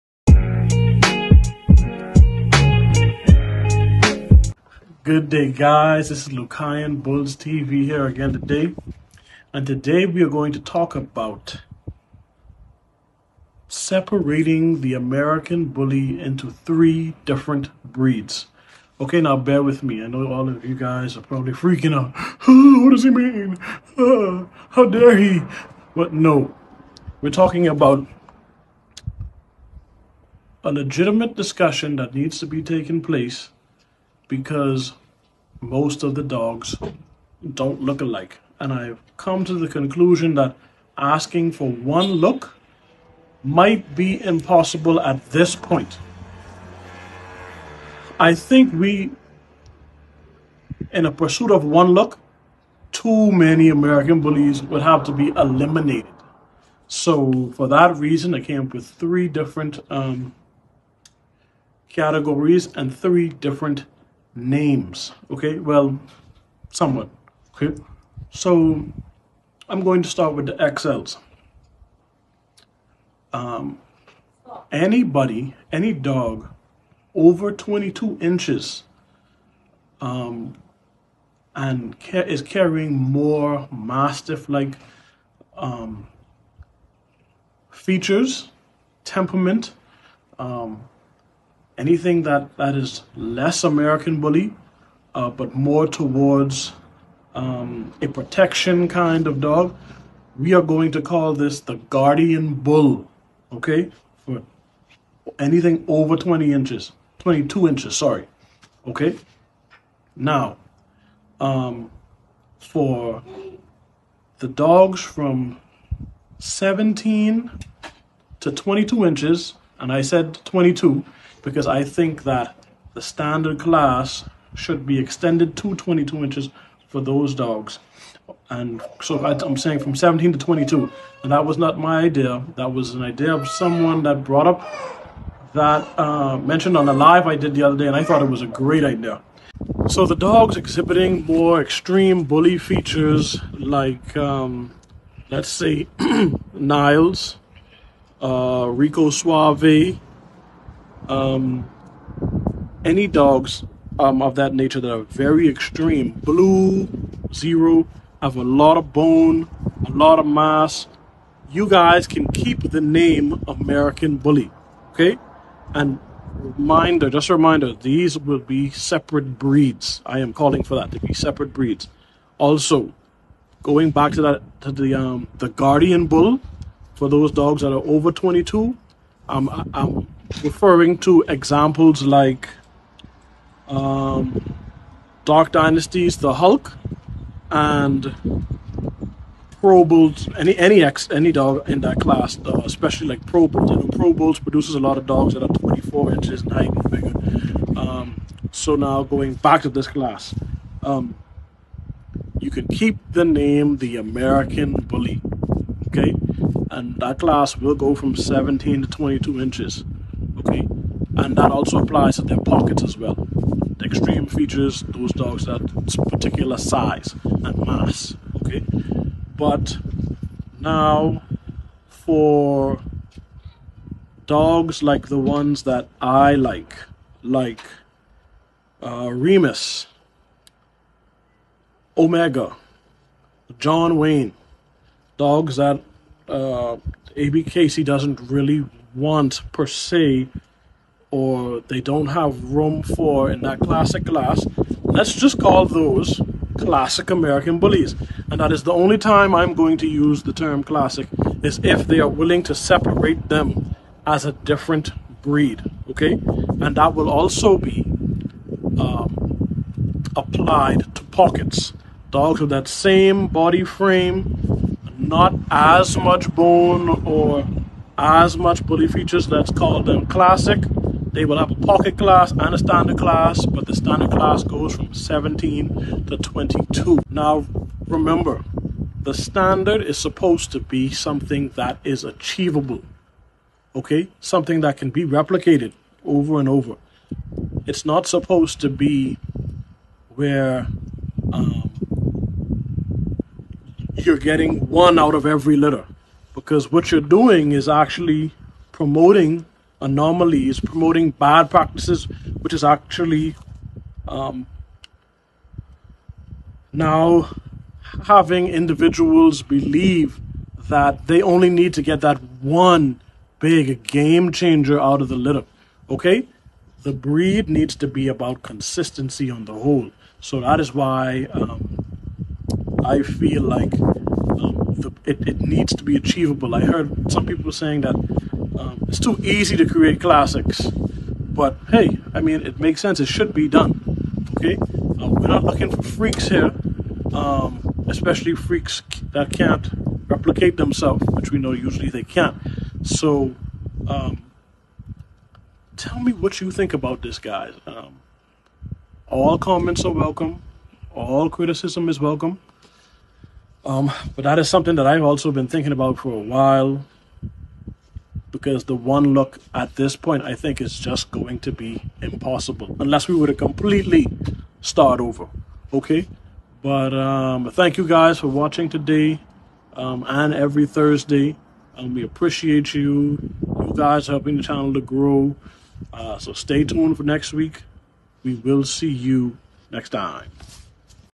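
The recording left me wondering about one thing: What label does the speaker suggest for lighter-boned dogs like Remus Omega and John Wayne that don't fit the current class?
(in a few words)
classic American bullies.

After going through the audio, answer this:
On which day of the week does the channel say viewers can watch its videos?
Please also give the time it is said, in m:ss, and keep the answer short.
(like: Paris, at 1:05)
Thursday, at 6:10.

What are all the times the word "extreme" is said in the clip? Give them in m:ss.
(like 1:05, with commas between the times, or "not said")
2:21, 2:35, 3:33.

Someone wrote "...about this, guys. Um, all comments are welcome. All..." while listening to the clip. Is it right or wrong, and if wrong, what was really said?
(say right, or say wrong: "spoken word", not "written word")
right.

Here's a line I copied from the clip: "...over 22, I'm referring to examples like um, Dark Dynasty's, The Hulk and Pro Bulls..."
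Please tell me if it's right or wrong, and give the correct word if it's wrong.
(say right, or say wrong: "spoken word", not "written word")
right.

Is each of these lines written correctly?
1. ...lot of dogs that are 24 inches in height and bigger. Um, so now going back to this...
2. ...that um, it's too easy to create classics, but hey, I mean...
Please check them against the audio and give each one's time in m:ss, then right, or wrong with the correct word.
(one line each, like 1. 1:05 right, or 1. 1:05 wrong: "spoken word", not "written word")
1. 3:14 right
2. 5:27 right.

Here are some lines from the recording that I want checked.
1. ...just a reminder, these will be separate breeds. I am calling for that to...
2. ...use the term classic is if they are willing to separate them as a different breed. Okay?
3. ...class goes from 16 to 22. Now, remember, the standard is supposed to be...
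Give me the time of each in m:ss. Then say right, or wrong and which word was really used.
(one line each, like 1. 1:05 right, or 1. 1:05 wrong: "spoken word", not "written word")
1. 2:47 right
2. 4:09 right
3. 4:34 wrong: "17", not "16".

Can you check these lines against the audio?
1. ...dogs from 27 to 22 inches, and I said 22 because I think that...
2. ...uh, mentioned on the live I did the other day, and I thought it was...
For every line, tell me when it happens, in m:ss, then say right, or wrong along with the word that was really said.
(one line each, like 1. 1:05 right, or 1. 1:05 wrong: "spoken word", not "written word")
1. 1:54 wrong: "17", not "27"
2. 2:15 right.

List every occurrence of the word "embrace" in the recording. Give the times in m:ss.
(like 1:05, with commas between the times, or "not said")
not said.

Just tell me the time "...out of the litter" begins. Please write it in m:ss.
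5:14.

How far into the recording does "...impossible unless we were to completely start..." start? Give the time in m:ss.
6:02.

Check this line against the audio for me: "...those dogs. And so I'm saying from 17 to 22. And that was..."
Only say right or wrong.
right.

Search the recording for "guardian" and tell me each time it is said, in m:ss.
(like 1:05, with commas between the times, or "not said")
1:41, 2:55.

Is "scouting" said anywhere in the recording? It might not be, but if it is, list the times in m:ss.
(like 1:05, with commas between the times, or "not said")
not said.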